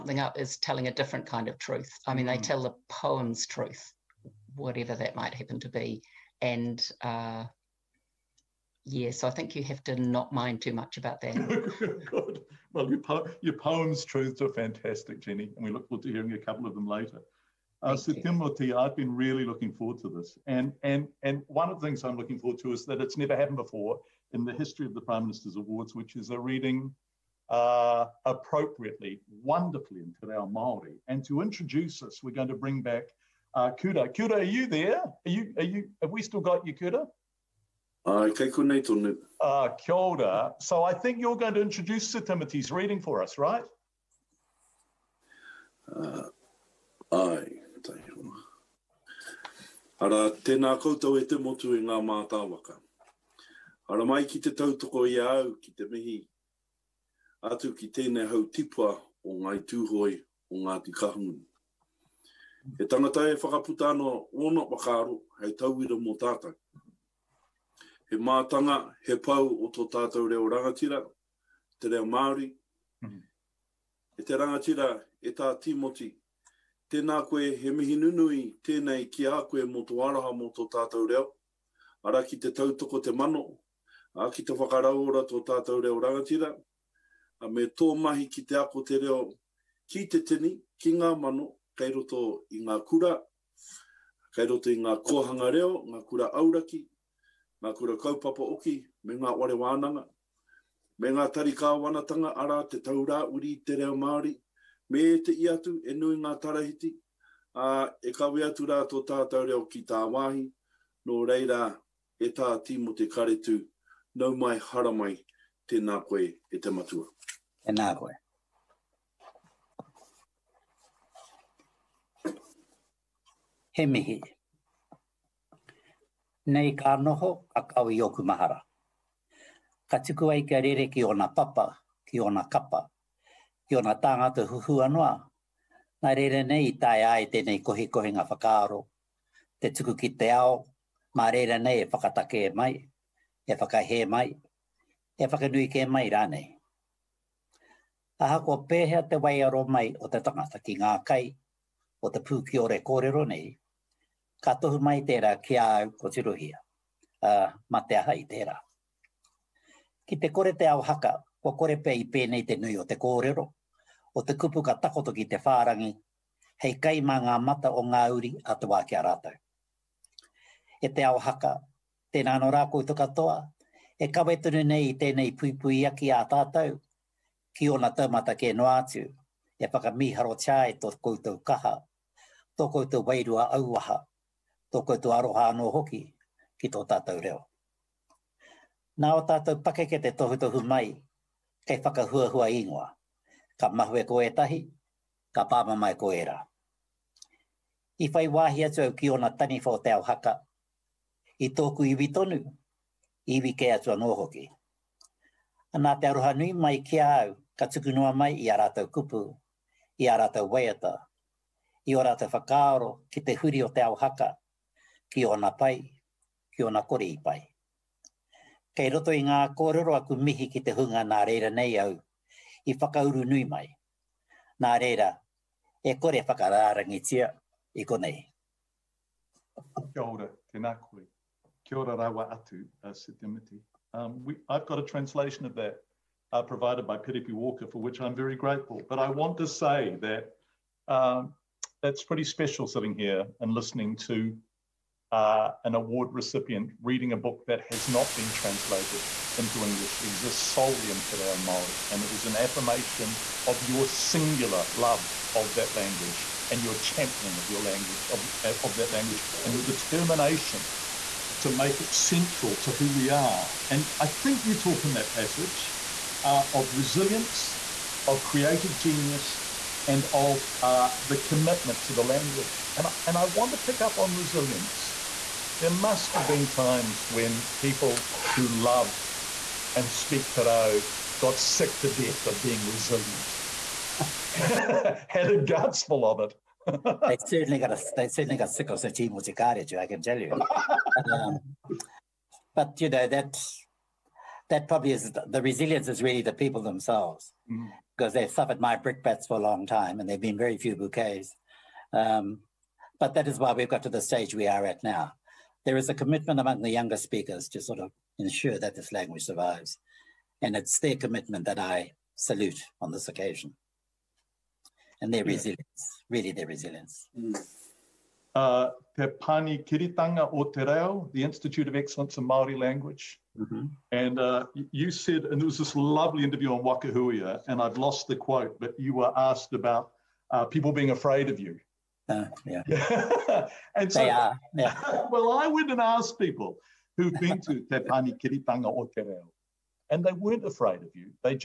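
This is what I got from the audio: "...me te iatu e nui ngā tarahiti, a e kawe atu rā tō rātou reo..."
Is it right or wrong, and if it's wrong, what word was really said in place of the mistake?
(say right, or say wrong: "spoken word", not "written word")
wrong: "tātou", not "rātou".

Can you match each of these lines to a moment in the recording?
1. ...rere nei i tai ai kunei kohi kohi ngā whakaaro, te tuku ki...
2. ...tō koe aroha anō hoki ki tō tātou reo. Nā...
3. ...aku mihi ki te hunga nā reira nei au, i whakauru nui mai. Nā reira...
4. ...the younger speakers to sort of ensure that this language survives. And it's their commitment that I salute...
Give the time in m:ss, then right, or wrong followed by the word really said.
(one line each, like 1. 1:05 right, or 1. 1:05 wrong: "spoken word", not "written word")
1. 2:16 wrong: "tēnei", not "kunei"
2. 3:04 right
3. 3:39 right
4. 5:06 right.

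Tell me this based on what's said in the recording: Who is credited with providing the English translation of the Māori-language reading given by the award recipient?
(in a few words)
Piripi Walker.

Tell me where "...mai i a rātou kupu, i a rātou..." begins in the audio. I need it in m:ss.
3:28.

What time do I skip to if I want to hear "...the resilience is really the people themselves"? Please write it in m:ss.
4:55.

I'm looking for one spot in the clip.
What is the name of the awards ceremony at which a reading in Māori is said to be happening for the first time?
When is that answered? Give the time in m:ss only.
0:25.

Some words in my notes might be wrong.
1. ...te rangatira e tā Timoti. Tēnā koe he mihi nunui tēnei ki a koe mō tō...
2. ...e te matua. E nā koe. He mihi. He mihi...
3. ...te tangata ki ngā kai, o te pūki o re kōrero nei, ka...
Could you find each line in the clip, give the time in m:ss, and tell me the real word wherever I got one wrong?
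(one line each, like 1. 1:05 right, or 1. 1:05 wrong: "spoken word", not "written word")
1. 1:14 right
2. 1:56 right
3. 2:30 right.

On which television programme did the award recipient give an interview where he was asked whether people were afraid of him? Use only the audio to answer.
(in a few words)
Waka Huia.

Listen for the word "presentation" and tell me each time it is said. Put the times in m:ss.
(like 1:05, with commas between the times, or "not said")
not said.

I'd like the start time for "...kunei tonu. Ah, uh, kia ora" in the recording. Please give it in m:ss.
0:38.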